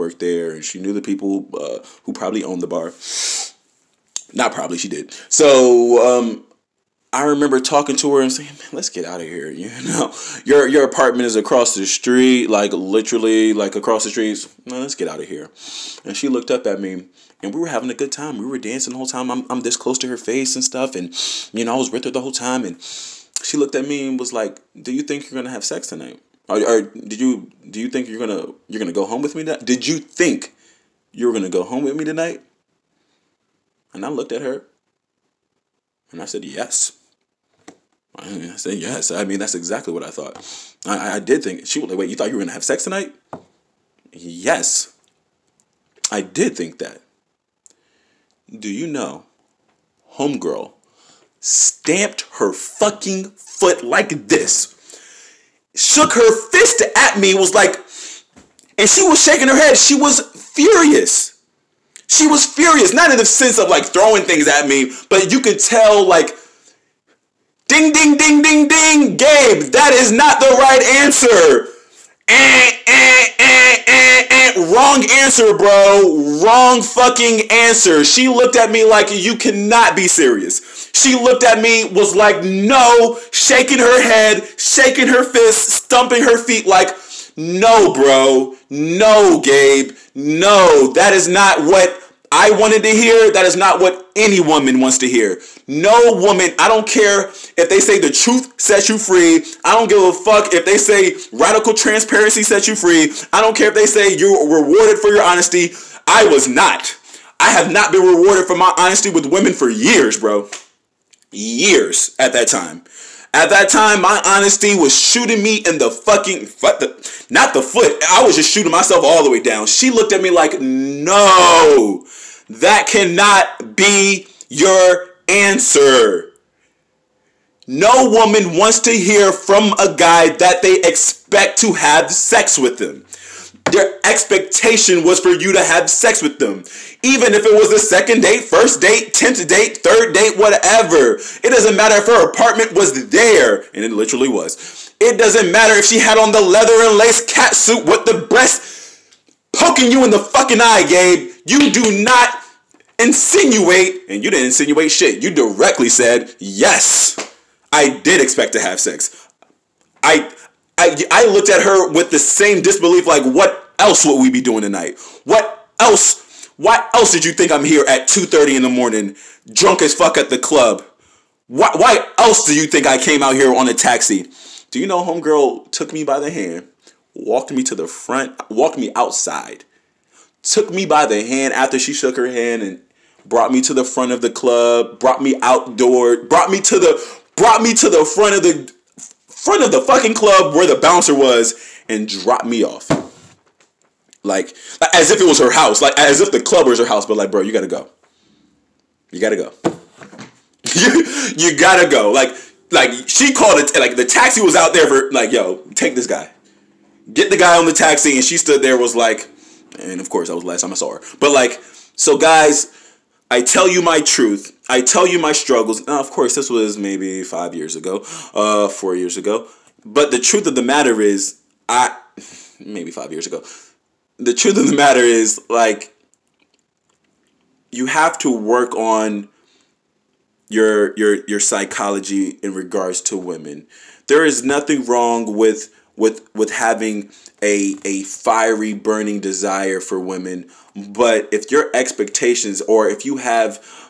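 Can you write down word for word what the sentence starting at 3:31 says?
But like, so guys, I tell you my truth.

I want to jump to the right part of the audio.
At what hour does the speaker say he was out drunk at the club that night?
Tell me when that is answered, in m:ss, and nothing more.
2:48.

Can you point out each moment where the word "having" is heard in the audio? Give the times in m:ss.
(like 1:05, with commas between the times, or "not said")
0:17, 3:56.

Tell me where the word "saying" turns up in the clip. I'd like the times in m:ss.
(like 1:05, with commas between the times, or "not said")
0:08.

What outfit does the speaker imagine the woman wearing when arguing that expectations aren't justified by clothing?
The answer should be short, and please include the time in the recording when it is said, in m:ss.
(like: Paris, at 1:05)
leather and lace cat suit, at 2:26.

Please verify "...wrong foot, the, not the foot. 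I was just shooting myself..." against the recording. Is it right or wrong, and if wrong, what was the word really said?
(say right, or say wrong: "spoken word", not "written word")
wrong: "fucking", not "wrong".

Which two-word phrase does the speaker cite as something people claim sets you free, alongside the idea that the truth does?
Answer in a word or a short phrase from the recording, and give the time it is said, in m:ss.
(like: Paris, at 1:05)
radical transparency, at 1:41.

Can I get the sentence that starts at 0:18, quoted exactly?
We were dancing the whole time.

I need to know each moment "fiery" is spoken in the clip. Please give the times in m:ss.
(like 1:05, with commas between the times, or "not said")
3:58.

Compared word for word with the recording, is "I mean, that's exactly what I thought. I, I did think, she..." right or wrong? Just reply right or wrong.
right.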